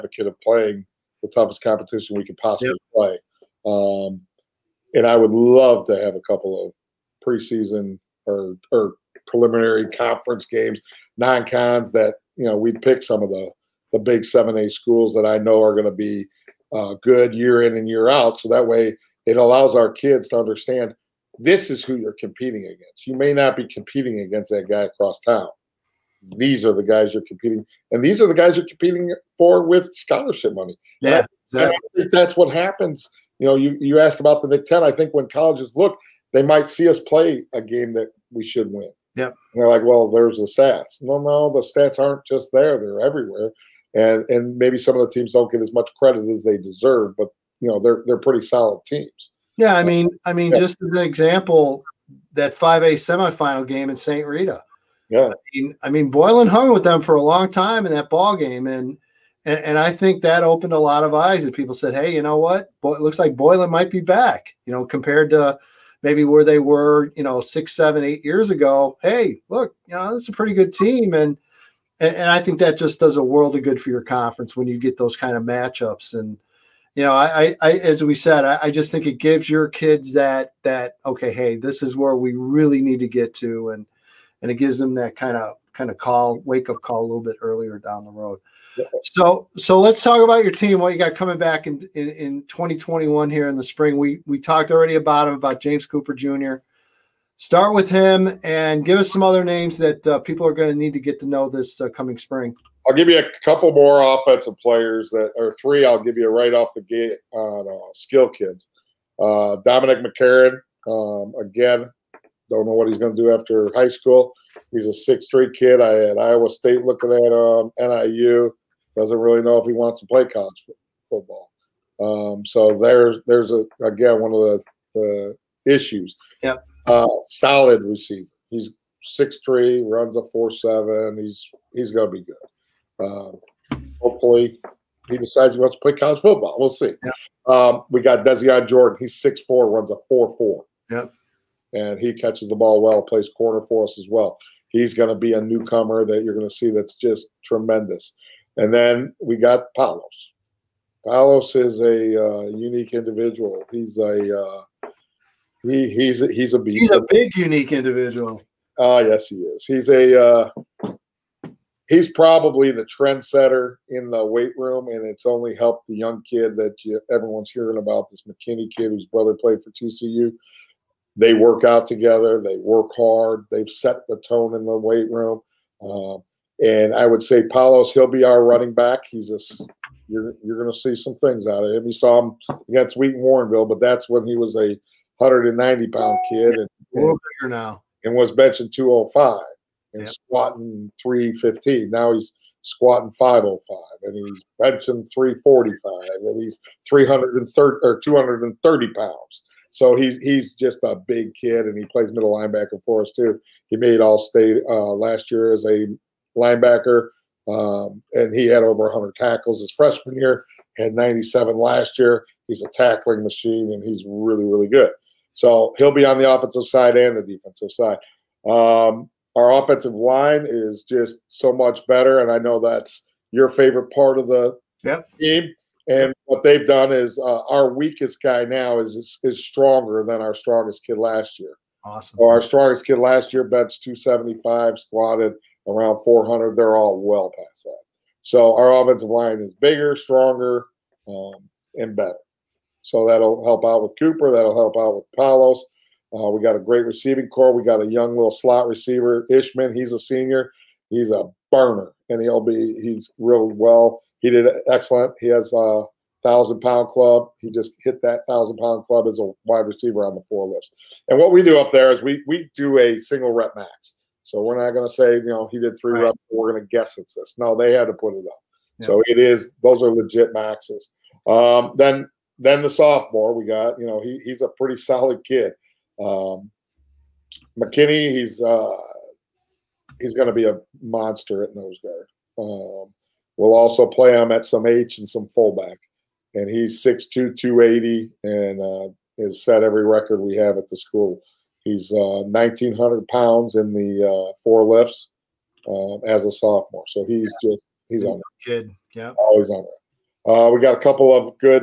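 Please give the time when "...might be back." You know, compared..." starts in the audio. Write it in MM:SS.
01:03.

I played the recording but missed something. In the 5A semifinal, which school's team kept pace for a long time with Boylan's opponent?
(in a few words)
St. Rita.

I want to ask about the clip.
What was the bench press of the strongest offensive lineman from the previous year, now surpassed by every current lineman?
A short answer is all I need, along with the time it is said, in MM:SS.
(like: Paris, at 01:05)
275, at 03:53.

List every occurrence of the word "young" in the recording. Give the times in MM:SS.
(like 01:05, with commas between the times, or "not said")
02:45, 04:07.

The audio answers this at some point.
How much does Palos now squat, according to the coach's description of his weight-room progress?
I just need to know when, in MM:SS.
03:12.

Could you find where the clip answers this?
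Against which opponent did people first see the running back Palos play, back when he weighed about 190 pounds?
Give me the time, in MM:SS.
03:02.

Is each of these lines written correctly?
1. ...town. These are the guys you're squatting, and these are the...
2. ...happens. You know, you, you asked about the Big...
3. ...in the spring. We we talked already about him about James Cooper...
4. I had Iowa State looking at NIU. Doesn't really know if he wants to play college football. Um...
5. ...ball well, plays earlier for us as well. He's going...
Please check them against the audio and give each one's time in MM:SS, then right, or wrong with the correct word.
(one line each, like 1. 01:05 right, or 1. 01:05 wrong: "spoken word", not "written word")
1. 00:25 wrong: "competing", not "squatting"
2. 00:32 right
3. 01:33 right
4. 01:55 right
5. 02:22 wrong: "corner", not "earlier".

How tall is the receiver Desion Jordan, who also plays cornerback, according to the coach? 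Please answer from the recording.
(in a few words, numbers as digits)
6'4".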